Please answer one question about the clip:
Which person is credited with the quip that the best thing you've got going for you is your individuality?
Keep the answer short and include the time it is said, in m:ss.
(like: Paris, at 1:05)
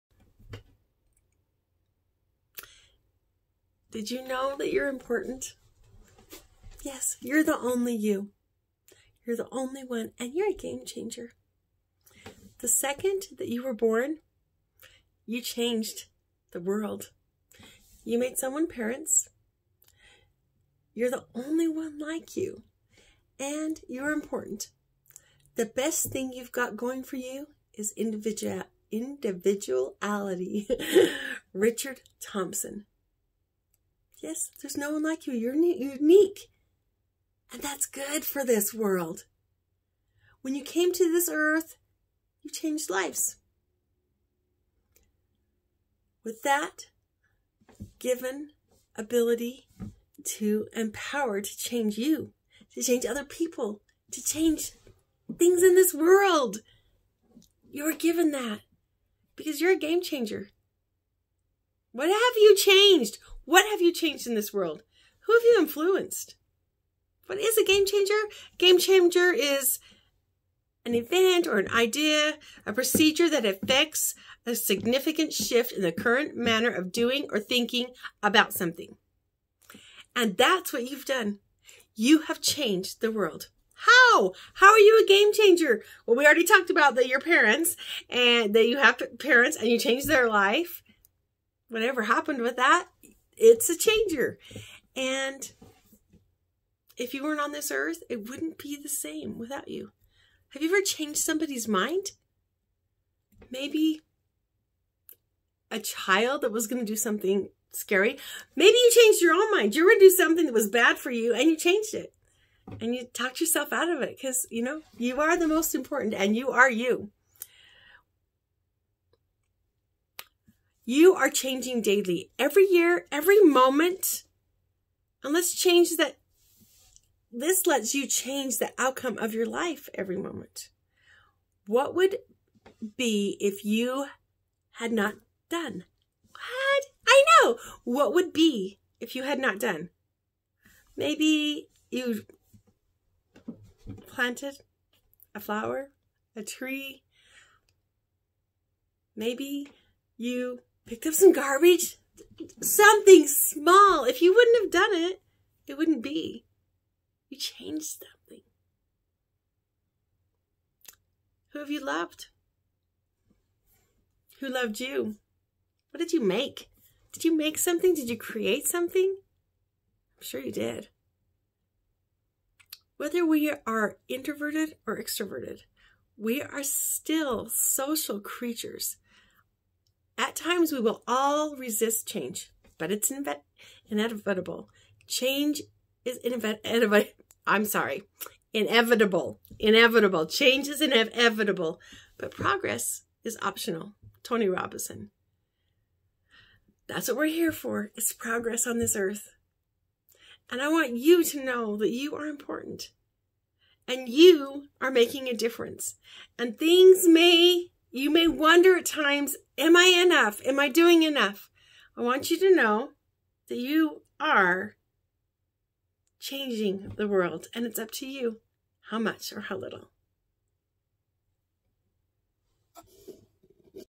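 Richard Thompson, at 0:31.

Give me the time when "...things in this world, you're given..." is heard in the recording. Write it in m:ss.
0:55.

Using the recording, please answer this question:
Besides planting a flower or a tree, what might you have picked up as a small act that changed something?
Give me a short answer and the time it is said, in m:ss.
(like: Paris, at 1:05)
garbage, at 2:31.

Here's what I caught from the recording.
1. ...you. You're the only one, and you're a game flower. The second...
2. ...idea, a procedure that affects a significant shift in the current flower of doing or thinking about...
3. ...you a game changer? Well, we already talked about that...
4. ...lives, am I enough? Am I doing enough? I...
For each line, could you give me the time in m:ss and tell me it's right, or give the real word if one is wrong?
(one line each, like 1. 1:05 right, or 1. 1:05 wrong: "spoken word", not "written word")
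1. 0:07 wrong: "changer", not "flower"
2. 1:11 wrong: "manner", not "flower"
3. 1:24 right
4. 3:28 wrong: "times", not "lives".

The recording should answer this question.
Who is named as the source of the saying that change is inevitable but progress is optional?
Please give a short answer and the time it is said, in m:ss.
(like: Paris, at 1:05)
Tony Robinson, at 3:14.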